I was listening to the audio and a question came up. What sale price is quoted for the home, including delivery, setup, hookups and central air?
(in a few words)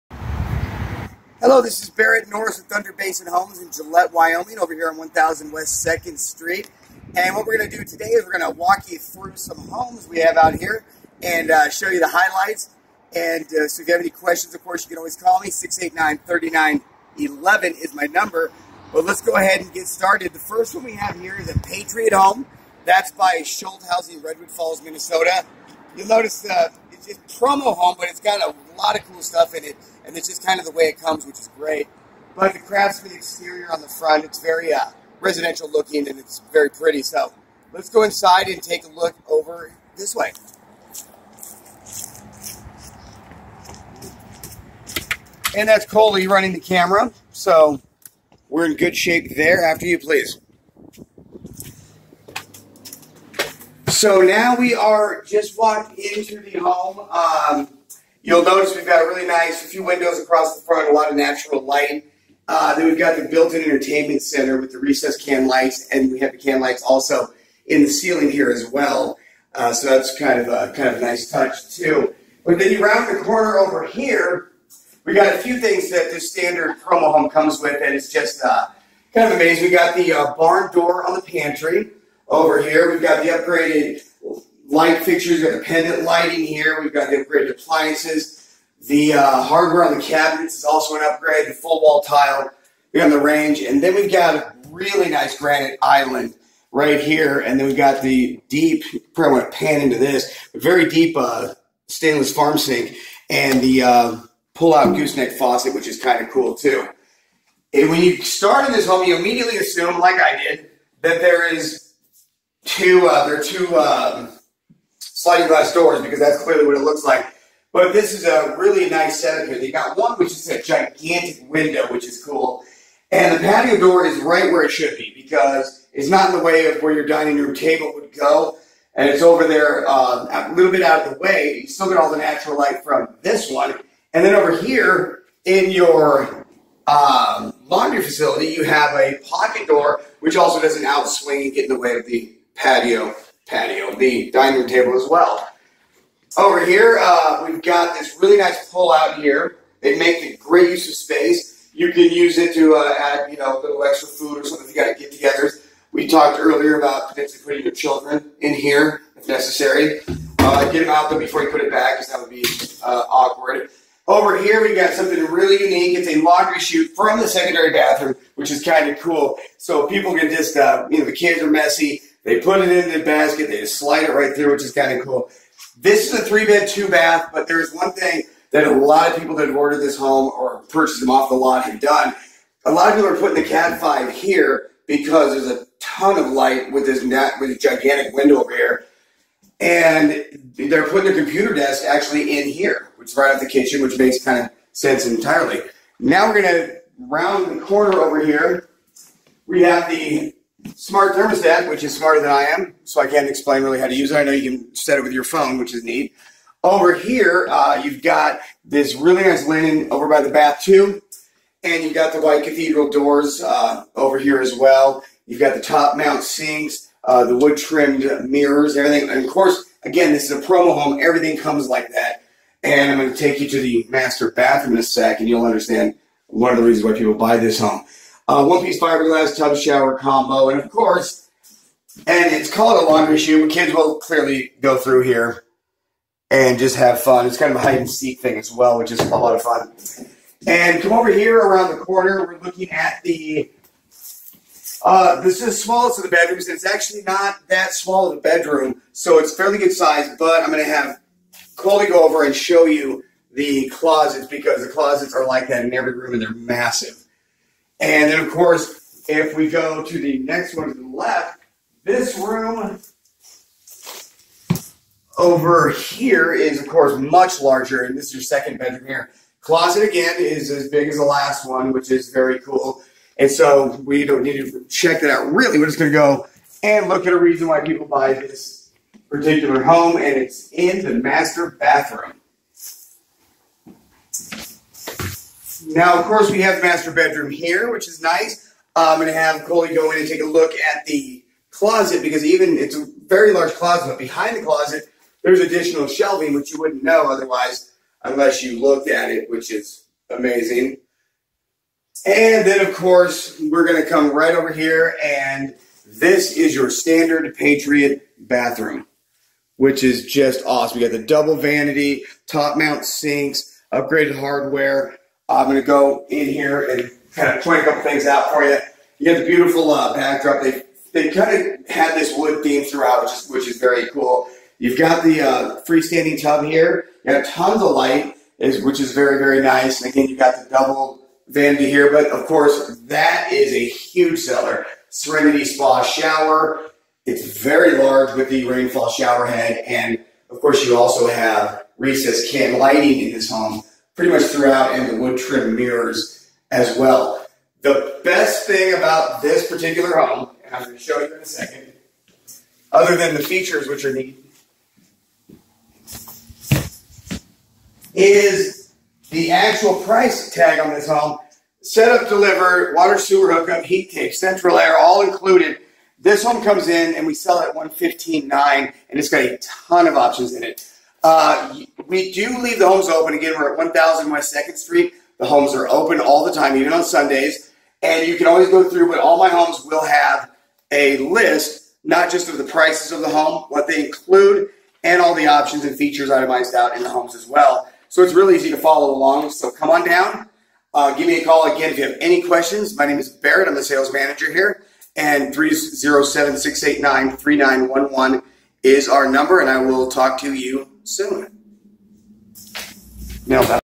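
115.9.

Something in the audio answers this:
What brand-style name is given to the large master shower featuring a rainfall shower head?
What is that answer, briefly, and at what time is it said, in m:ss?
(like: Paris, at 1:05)
Serenity Spa, at 5:34.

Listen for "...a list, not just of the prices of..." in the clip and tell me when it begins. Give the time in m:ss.
6:20.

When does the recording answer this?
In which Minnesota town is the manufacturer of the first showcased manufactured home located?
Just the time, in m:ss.
0:24.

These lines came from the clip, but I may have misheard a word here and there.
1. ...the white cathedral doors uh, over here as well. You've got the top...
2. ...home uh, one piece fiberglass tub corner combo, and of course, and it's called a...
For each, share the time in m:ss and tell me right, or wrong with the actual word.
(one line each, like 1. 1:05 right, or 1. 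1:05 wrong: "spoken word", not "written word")
1. 3:32 right
2. 3:47 wrong: "shower", not "corner".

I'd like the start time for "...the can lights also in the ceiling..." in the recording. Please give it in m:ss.
1:06.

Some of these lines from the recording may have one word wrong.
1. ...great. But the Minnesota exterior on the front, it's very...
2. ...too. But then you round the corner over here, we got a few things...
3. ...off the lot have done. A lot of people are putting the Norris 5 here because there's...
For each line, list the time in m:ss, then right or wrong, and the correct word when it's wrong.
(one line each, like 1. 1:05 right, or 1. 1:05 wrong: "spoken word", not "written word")
1. 0:31 wrong: "Craftsman", not "Minnesota"
2. 1:11 right
3. 3:01 wrong: "Cat", not "Norris".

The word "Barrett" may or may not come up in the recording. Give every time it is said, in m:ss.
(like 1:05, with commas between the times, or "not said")
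0:01, 6:33.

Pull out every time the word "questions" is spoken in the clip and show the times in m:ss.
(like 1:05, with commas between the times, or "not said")
0:14, 6:32.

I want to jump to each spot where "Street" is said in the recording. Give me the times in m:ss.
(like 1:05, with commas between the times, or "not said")
0:06, 6:14.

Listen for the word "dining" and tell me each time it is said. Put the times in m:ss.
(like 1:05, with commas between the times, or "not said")
2:07, 2:24.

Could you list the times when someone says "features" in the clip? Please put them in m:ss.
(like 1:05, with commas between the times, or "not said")
5:53, 6:25.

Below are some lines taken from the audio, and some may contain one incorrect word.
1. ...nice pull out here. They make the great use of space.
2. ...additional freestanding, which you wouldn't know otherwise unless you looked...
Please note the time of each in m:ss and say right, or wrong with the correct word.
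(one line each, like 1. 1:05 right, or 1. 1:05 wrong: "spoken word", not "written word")
1. 2:28 right
2. 4:55 wrong: "shelving", not "freestanding".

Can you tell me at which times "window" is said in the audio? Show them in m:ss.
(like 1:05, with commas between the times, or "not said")
0:59, 2:01, 3:08.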